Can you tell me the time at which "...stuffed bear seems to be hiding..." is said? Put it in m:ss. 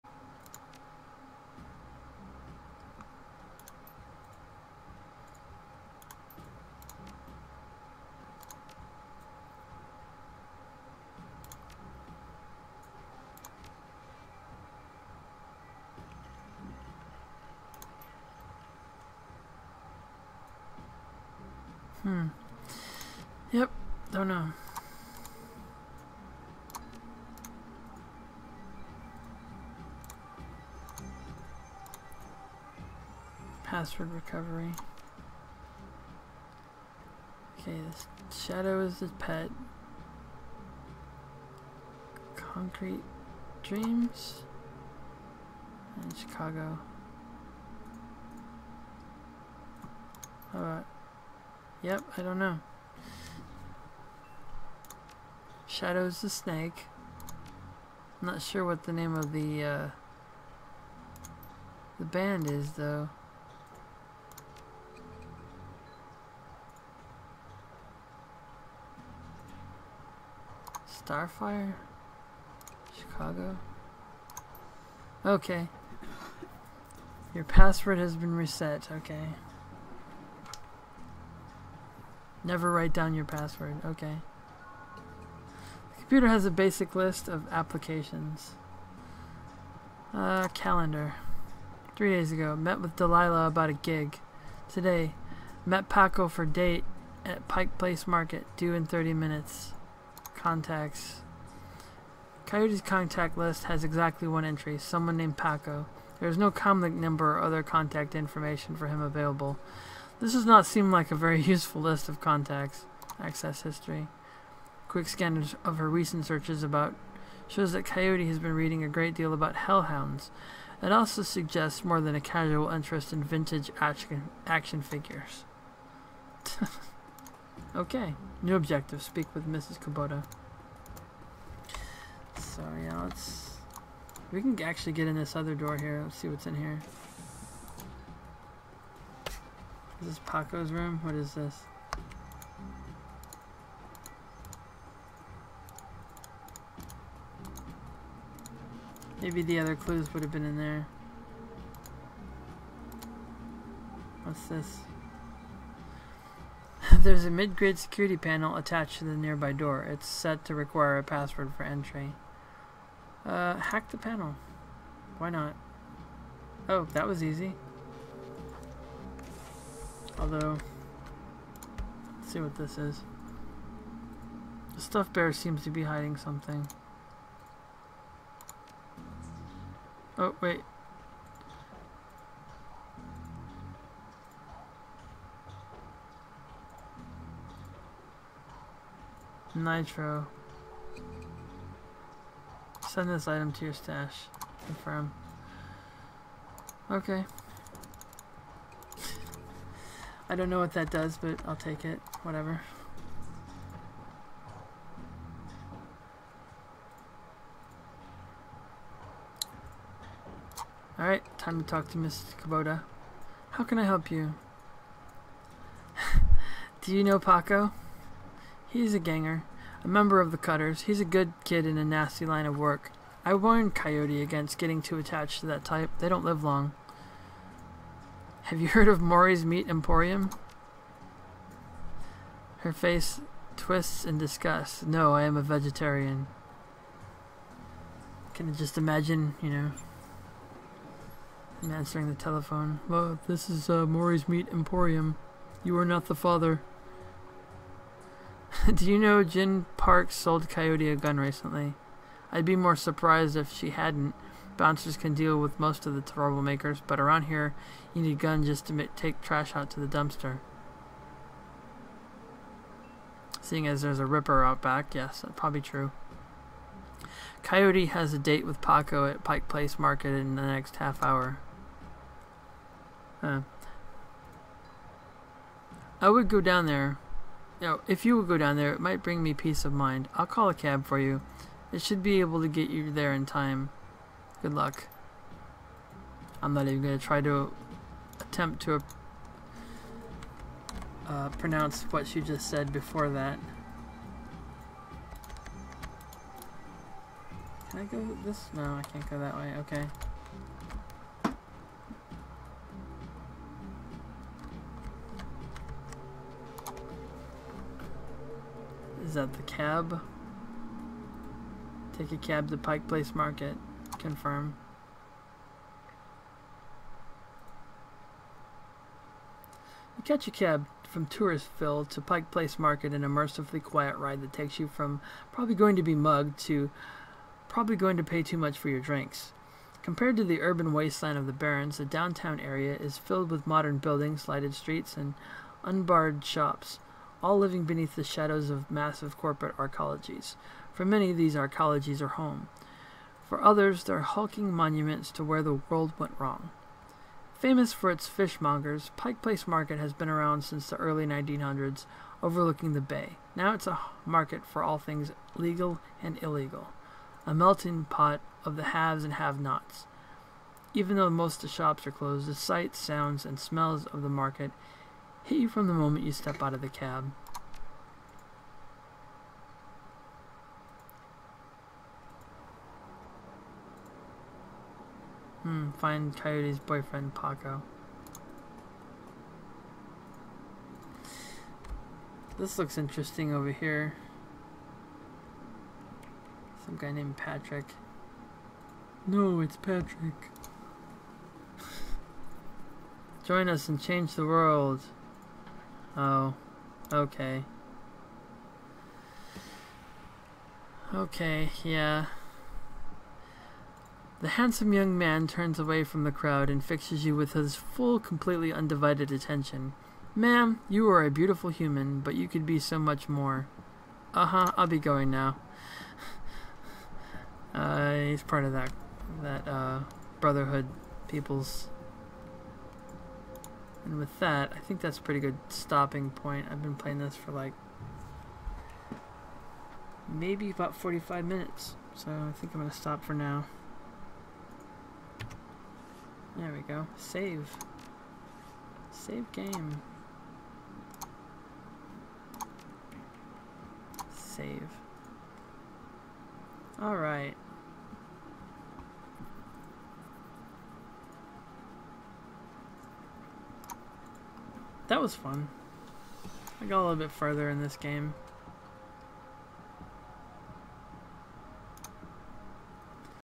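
2:54.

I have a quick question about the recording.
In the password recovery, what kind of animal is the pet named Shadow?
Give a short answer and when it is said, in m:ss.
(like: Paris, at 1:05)
Snake, at 0:55.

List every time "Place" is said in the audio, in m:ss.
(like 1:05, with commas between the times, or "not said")
1:37, 4:29, 5:12, 5:22, 5:49.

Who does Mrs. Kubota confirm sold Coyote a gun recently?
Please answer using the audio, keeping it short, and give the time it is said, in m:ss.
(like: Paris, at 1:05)
Jin Park, at 4:09.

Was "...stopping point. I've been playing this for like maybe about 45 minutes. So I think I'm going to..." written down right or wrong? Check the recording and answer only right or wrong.
right.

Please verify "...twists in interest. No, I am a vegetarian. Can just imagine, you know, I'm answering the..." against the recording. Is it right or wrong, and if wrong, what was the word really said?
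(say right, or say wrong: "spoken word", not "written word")
wrong: "disgust", not "interest".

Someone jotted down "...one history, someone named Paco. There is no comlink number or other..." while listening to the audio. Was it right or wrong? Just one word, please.
wrong.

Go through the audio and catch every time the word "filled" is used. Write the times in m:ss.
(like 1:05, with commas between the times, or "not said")
5:32.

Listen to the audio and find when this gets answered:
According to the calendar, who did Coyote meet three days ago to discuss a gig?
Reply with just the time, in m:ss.
1:32.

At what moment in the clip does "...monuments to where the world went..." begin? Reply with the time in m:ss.
5:44.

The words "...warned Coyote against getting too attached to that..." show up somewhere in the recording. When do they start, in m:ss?
3:43.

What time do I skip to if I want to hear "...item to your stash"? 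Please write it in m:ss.
3:13.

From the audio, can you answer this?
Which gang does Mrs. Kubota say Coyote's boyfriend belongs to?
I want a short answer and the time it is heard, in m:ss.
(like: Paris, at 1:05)
The Cutters, at 3:40.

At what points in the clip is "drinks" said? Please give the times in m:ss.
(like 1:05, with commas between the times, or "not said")
5:28.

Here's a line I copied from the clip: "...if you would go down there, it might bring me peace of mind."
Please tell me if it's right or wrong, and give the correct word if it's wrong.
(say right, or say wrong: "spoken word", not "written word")
right.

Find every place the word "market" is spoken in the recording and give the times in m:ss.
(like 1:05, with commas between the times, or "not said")
1:38, 4:29, 5:13, 5:22, 5:49, 5:54, 6:04.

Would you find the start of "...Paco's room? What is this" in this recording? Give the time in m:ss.
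2:20.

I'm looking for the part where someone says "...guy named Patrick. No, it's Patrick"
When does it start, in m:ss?
6:26.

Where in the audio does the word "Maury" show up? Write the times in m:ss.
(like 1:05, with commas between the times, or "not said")
3:49, 4:03.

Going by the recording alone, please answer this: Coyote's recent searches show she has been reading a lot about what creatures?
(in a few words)
Hellhounds.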